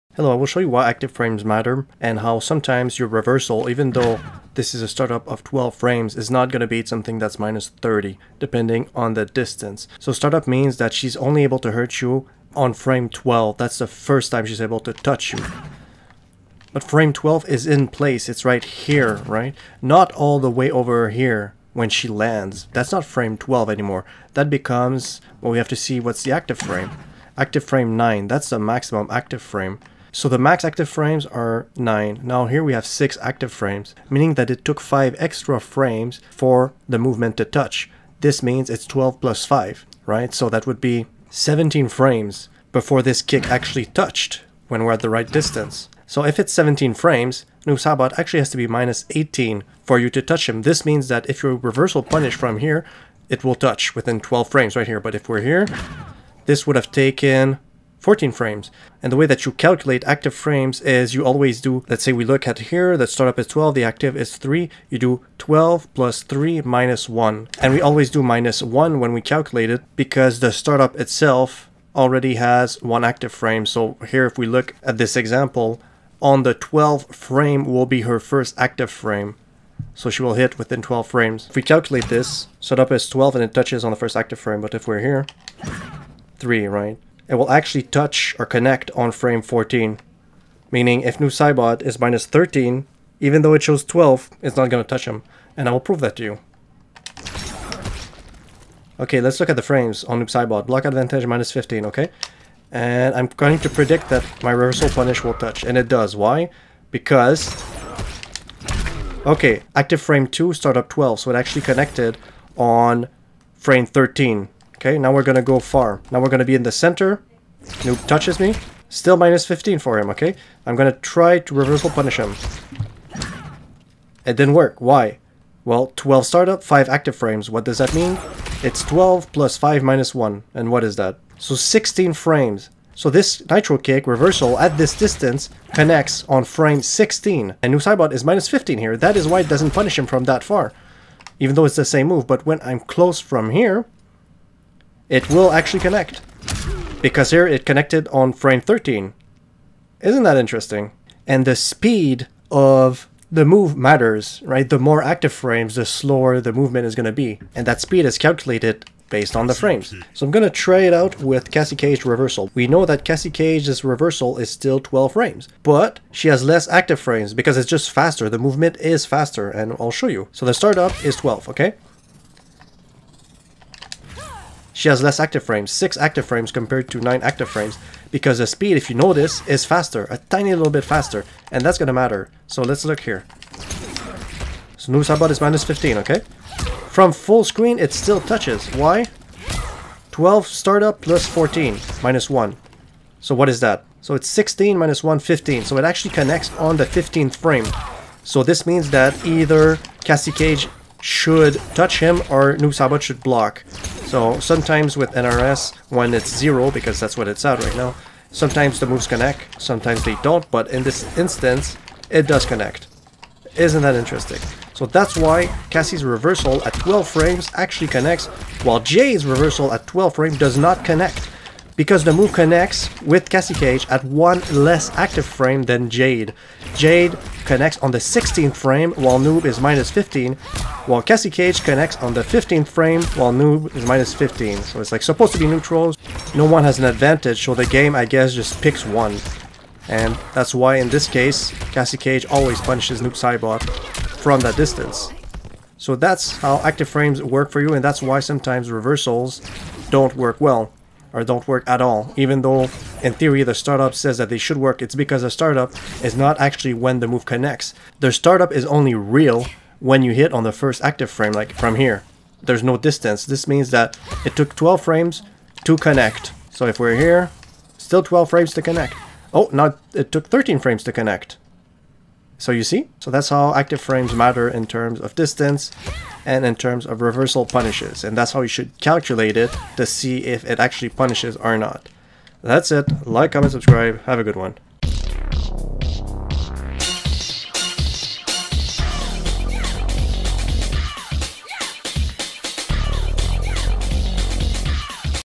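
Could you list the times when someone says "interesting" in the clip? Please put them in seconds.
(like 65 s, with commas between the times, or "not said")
150 s, 213 s.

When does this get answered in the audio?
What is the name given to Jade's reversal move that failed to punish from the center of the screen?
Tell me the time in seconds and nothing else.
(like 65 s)
133 s.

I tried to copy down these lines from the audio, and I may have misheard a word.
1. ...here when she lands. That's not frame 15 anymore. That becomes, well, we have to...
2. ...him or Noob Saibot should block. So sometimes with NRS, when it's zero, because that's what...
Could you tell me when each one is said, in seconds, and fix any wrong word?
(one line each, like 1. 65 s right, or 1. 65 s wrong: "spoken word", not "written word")
1. 21 s wrong: "12", not "15"
2. 201 s right.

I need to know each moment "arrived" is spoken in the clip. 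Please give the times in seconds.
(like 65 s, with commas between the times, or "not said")
not said.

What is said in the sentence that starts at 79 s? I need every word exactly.
So she will hit within 12 frames.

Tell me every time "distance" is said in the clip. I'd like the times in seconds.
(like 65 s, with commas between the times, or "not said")
9 s, 45 s, 134 s, 244 s, 262 s, 275 s.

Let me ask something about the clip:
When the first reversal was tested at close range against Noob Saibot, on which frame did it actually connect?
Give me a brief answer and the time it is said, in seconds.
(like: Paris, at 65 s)
13, at 111 s.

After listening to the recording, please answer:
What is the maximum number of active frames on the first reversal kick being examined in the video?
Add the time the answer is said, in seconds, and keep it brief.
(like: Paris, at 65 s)
9, at 30 s.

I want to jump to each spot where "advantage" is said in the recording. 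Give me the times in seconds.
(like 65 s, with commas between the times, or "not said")
100 s, 236 s.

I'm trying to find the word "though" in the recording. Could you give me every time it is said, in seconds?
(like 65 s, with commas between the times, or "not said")
3 s, 93 s, 141 s, 252 s.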